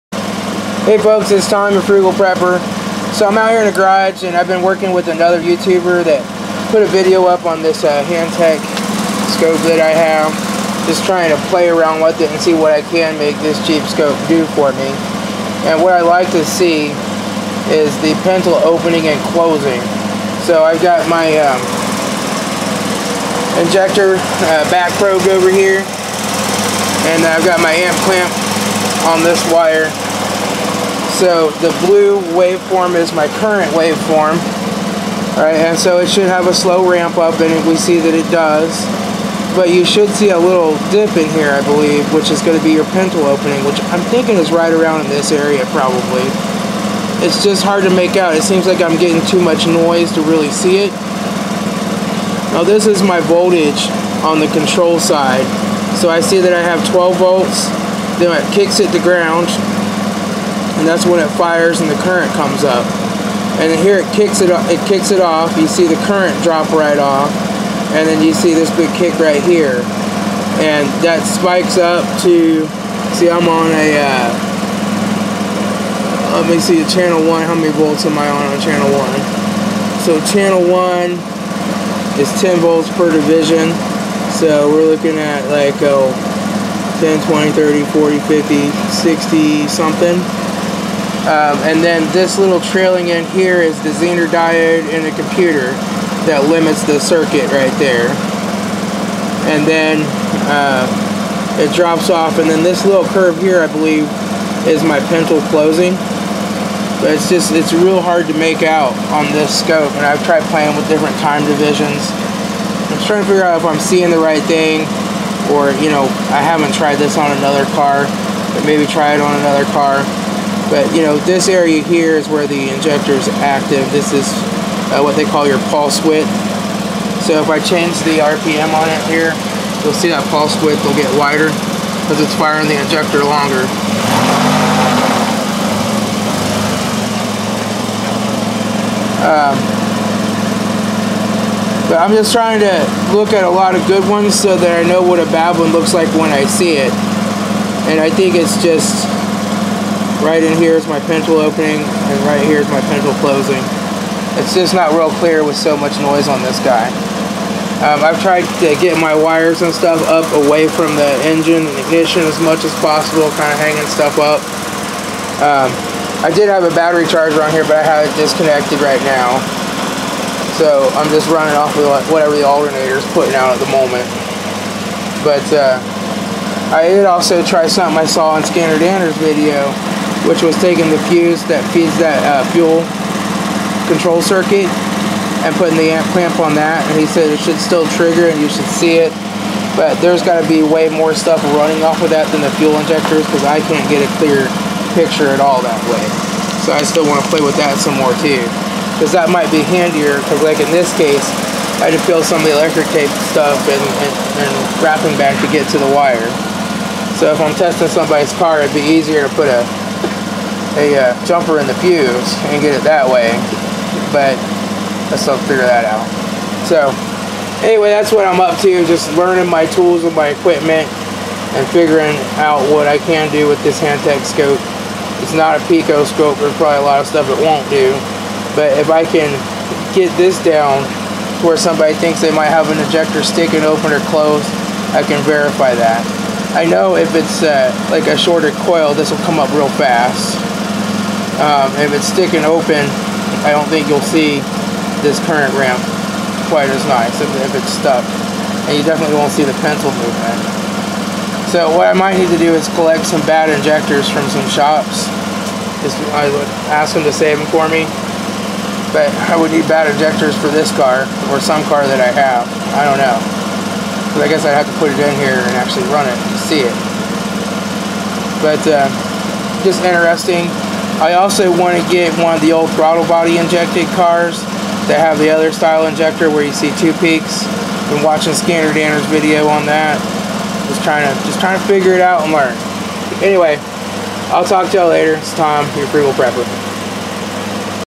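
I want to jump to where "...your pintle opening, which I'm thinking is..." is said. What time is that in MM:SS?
00:42.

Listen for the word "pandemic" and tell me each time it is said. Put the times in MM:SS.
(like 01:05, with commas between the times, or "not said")
not said.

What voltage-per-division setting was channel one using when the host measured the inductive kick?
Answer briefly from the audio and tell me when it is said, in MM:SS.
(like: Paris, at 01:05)
10 volts, at 01:22.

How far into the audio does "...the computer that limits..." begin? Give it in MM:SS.
01:35.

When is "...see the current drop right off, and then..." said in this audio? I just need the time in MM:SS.
01:05.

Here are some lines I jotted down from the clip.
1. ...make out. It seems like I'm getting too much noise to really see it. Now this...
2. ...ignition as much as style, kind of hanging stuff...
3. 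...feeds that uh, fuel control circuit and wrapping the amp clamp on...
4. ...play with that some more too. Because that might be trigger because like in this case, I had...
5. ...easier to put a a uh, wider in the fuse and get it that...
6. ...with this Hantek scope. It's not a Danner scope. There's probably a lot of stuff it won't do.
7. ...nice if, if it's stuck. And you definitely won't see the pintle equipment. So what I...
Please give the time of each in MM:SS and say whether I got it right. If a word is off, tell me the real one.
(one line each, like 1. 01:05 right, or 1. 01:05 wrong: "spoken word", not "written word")
1. 00:47 right
2. 02:41 wrong: "possible", not "style"
3. 03:01 wrong: "putting", not "wrapping"
4. 03:17 wrong: "handier", not "trigger"
5. 03:28 wrong: "jumper", not "wider"
6. 03:43 wrong: "Pico", not "Danner"
7. 04:06 wrong: "movement", not "equipment".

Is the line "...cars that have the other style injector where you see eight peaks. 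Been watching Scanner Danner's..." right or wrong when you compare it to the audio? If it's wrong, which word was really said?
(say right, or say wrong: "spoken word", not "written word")
wrong: "two", not "eight".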